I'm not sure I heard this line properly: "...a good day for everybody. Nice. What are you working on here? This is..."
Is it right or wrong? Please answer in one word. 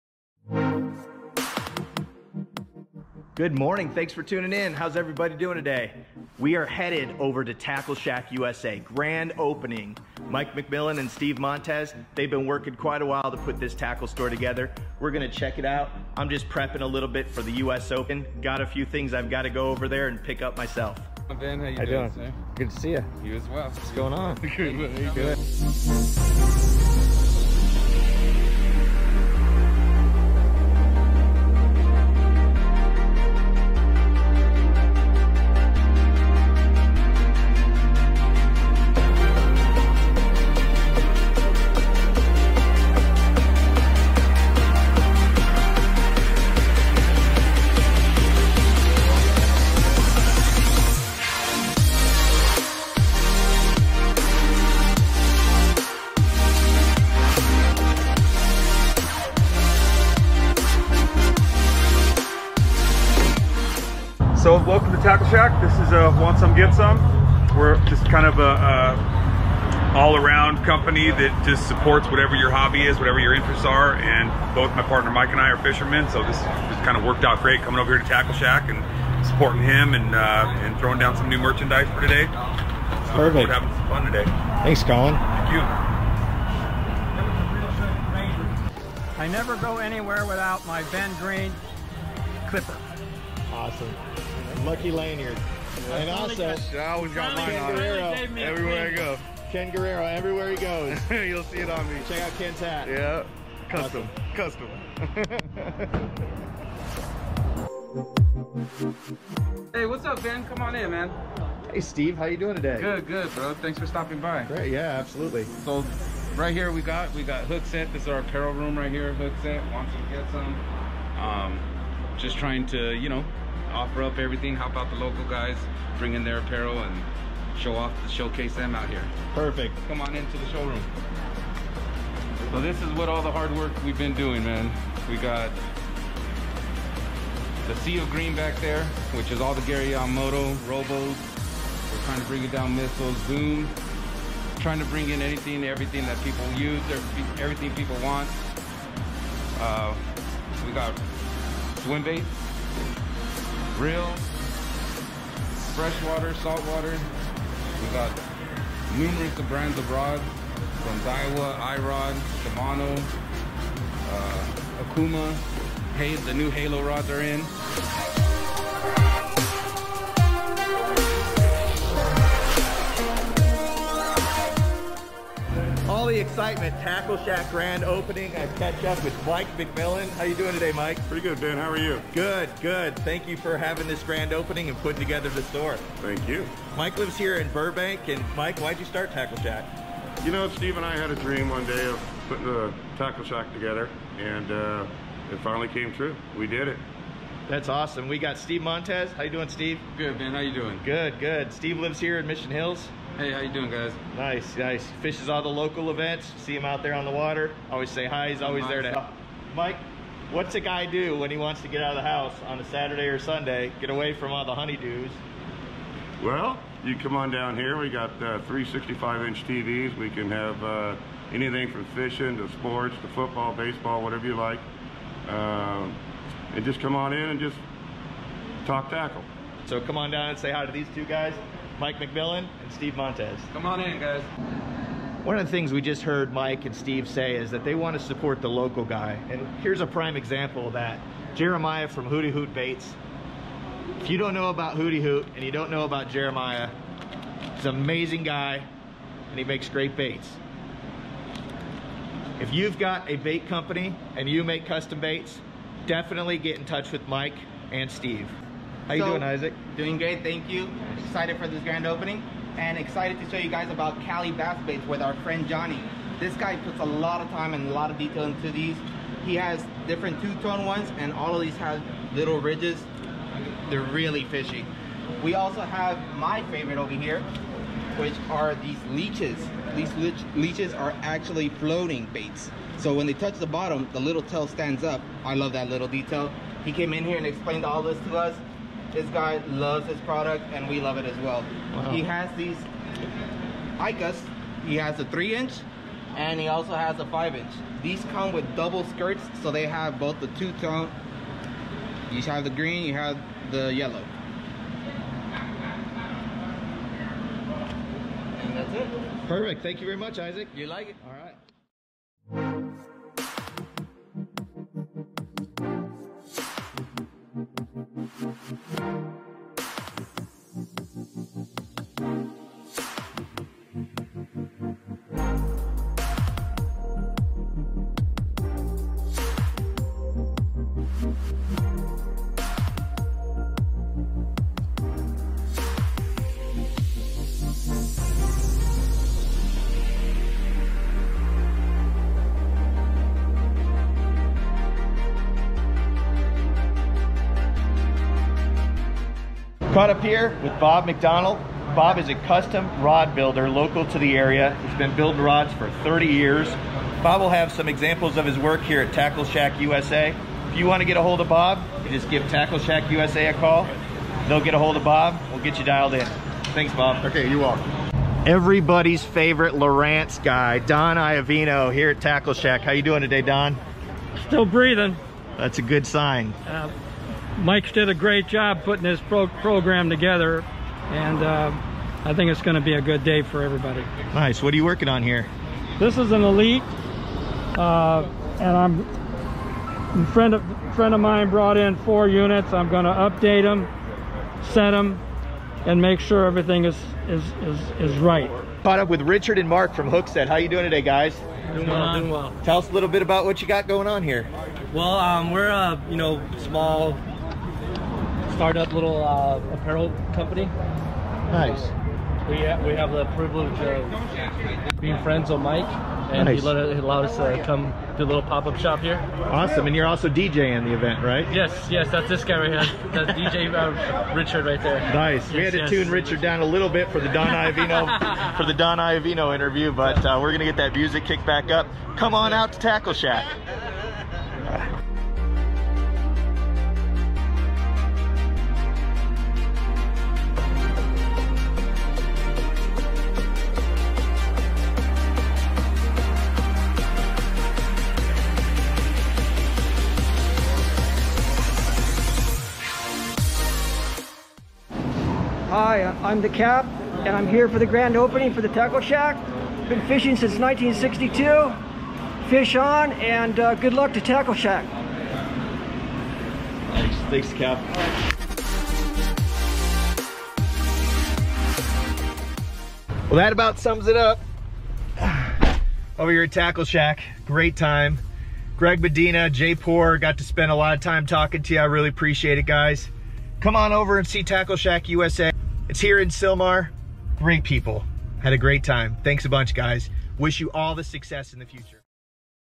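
right.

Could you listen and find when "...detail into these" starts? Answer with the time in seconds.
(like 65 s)
267 s.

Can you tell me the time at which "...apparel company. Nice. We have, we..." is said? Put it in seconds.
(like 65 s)
409 s.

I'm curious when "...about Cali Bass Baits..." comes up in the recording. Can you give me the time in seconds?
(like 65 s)
263 s.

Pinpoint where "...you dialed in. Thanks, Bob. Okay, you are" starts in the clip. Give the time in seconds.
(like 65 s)
365 s.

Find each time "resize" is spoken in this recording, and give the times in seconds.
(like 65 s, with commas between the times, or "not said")
not said.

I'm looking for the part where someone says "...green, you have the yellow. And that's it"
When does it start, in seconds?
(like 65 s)
302 s.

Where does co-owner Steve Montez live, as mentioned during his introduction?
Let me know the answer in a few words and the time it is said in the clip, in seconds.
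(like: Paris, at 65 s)
Mission Hills, at 202 s.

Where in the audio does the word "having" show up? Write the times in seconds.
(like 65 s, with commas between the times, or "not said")
83 s, 183 s.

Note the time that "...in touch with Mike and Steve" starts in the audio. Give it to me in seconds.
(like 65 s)
256 s.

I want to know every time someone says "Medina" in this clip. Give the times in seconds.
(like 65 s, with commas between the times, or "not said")
478 s.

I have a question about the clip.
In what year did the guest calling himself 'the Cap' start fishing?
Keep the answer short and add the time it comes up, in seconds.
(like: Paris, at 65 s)
1962, at 460 s.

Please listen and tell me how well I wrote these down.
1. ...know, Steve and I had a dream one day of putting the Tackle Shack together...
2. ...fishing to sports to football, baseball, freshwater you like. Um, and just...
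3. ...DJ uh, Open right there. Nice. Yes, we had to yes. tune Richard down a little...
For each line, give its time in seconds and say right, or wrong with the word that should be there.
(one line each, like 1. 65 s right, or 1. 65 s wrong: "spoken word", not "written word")
1. 190 s right
2. 221 s wrong: "whatever", not "freshwater"
3. 423 s wrong: "Richard", not "Open".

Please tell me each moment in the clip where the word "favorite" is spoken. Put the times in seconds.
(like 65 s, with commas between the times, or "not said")
276 s, 369 s.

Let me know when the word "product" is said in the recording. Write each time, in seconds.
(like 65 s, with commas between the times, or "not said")
290 s.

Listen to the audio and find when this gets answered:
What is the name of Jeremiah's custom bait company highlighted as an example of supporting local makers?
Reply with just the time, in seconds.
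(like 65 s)
242 s.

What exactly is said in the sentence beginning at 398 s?
Caught up with Richard and Mark from Hookset.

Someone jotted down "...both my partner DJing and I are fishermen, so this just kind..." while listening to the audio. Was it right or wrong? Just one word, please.
wrong.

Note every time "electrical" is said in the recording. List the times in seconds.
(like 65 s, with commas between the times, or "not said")
not said.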